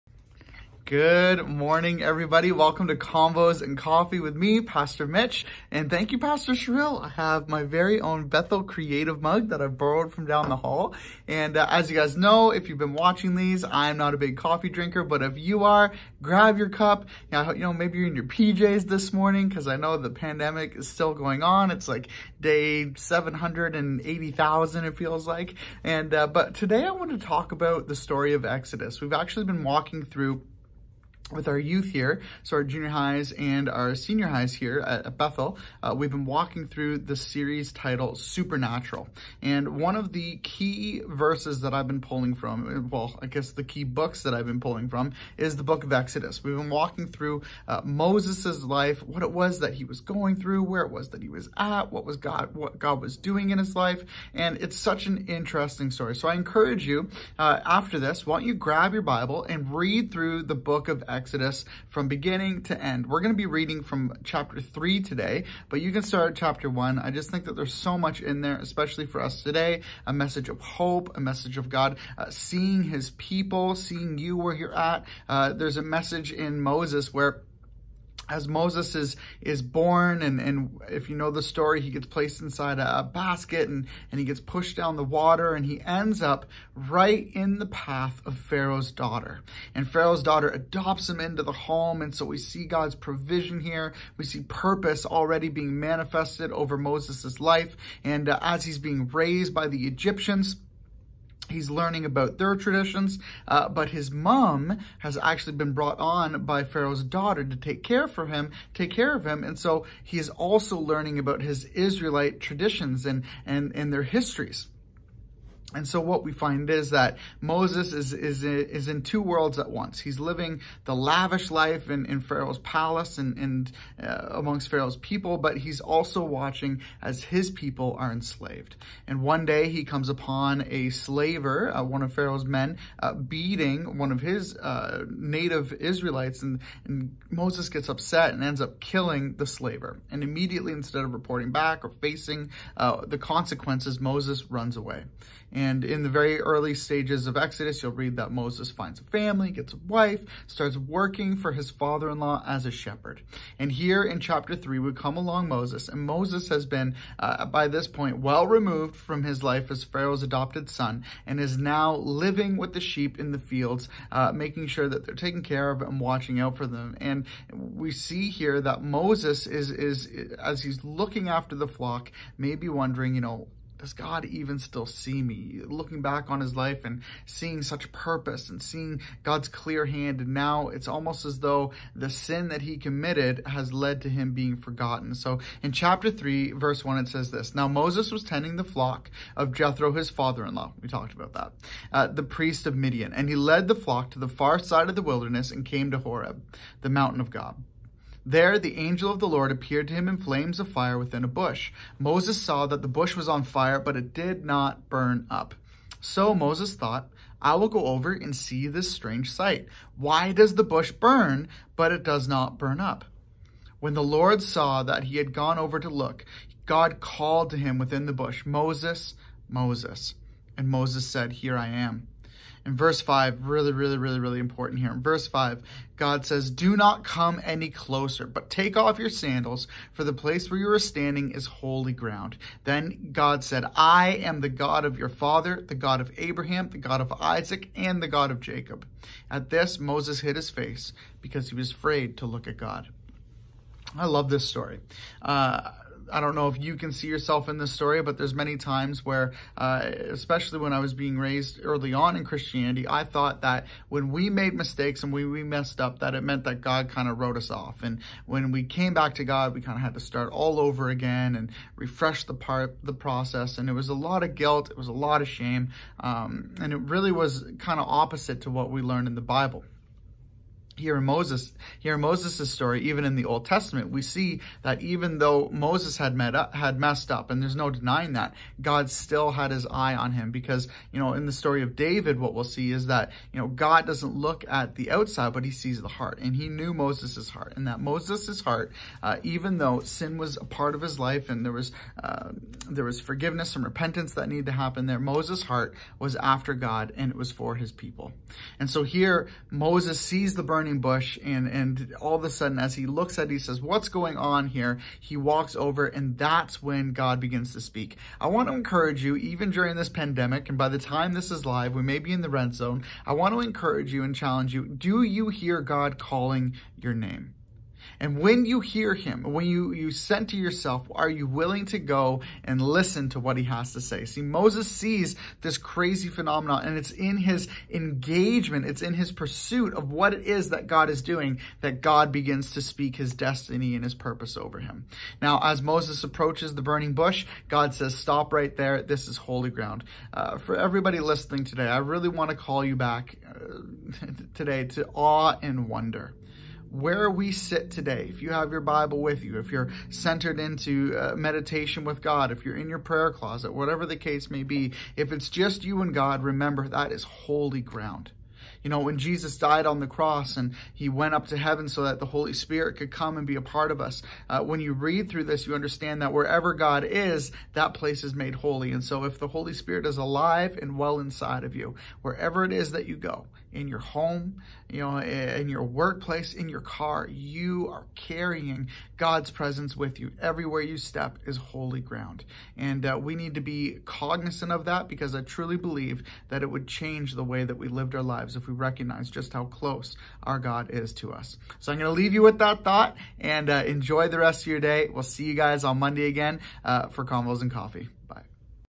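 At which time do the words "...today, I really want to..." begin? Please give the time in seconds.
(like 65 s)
341 s.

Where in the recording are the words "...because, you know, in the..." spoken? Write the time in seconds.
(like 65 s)
280 s.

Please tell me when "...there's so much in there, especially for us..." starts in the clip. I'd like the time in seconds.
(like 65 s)
67 s.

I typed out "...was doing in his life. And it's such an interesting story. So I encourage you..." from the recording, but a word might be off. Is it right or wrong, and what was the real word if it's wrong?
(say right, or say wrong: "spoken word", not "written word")
right.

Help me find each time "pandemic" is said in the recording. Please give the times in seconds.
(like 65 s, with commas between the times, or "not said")
20 s, 309 s.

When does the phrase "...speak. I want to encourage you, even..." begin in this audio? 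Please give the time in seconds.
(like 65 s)
307 s.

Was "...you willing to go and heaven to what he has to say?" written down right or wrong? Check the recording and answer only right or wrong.
wrong.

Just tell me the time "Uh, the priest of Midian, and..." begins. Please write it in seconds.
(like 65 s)
191 s.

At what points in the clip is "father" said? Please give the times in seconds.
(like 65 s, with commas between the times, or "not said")
151 s, 190 s, 235 s.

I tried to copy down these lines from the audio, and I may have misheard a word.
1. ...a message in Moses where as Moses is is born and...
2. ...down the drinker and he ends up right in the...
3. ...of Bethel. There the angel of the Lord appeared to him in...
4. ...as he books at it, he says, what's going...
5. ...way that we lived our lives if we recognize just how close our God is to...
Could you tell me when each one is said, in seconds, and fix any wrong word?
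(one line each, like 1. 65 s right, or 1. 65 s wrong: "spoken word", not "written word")
1. 75 s right
2. 84 s wrong: "water", not "drinker"
3. 197 s wrong: "God", not "Bethel"
4. 302 s wrong: "looks", not "books"
5. 387 s right.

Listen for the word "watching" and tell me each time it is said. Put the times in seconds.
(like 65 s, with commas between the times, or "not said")
12 s, 126 s, 165 s.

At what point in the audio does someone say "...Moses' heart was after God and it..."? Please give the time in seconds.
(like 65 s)
294 s.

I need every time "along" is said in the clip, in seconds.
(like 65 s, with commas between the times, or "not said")
155 s.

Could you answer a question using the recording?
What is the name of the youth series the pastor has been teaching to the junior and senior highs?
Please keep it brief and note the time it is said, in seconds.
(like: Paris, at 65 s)
Supernatural, at 38 s.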